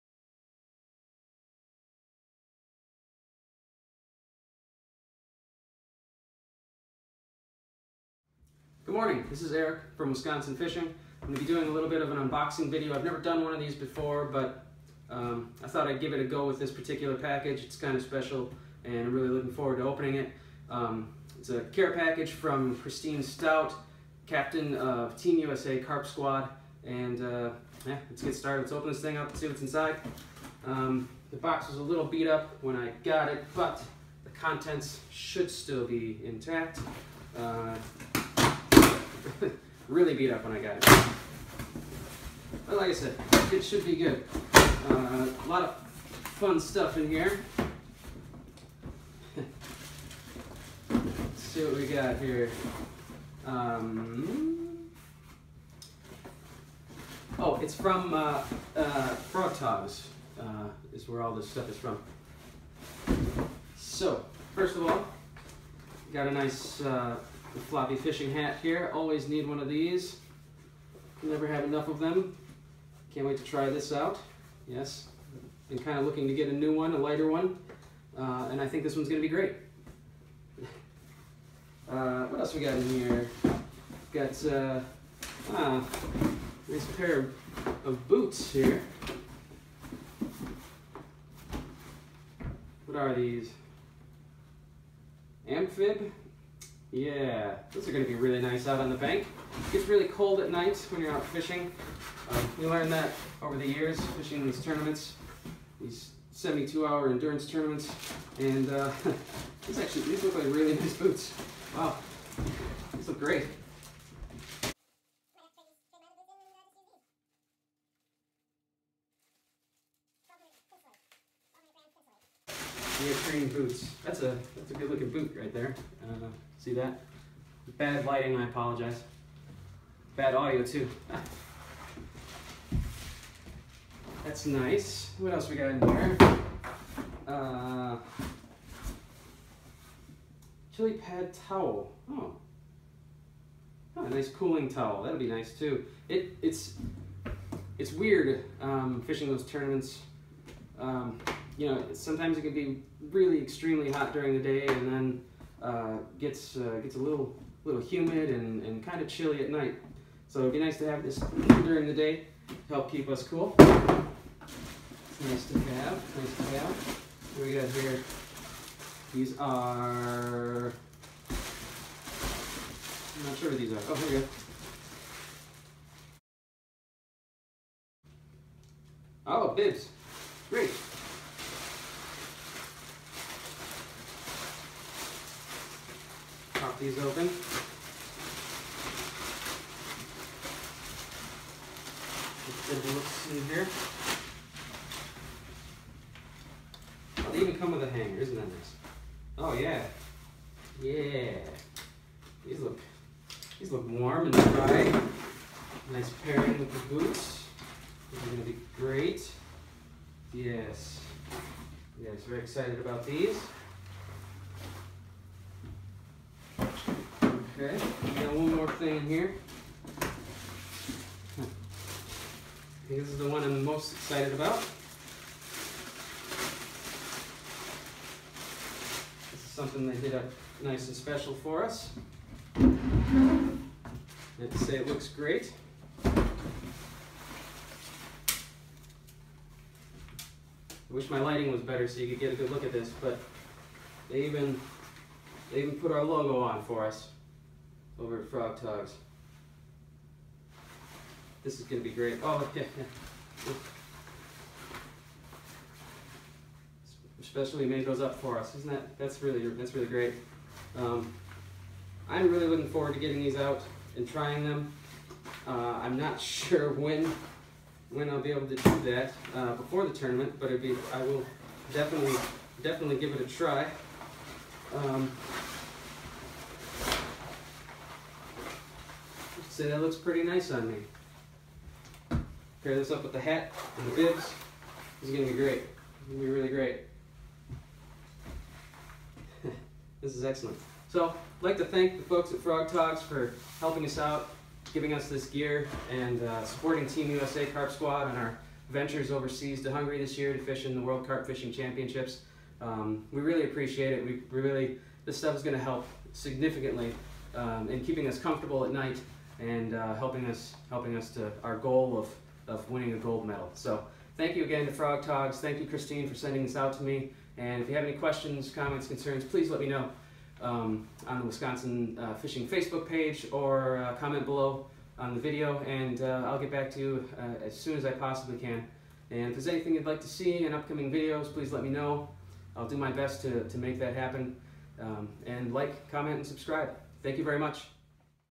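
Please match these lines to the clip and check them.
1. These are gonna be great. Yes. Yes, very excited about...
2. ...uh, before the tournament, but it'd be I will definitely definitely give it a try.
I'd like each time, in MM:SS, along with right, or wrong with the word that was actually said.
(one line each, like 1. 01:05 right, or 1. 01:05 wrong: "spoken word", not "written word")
1. 03:28 right
2. 04:29 right.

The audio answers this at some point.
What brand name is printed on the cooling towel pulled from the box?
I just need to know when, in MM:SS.
02:20.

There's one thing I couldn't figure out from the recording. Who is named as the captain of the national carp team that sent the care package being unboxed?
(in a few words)
Christine Stout.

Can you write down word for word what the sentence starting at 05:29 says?
And if there's anything you'd like to see in upcoming videos, please let me know.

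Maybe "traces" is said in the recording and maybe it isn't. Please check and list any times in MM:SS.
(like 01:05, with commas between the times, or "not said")
not said.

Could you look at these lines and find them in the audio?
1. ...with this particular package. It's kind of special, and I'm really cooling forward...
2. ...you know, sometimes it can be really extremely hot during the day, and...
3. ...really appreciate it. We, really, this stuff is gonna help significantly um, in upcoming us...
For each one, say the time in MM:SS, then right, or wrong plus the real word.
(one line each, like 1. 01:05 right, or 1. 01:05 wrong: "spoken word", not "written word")
1. 00:16 wrong: "looking", not "cooling"
2. 02:31 right
3. 05:03 wrong: "keeping", not "upcoming".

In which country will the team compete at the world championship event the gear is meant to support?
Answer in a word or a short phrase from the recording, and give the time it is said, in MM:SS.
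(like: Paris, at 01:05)
Hungary, at 04:59.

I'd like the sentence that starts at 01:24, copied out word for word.
Got uh, ah, nice pair of boots here.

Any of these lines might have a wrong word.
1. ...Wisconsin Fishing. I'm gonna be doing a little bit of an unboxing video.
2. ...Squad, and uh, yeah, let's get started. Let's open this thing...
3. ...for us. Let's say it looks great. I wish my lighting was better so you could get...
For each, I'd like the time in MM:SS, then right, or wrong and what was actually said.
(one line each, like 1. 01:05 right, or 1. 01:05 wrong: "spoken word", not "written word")
1. 00:10 right
2. 00:26 right
3. 03:51 right.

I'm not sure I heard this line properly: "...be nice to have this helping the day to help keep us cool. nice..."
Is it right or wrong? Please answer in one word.
wrong.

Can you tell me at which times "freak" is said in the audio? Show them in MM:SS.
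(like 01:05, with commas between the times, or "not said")
not said.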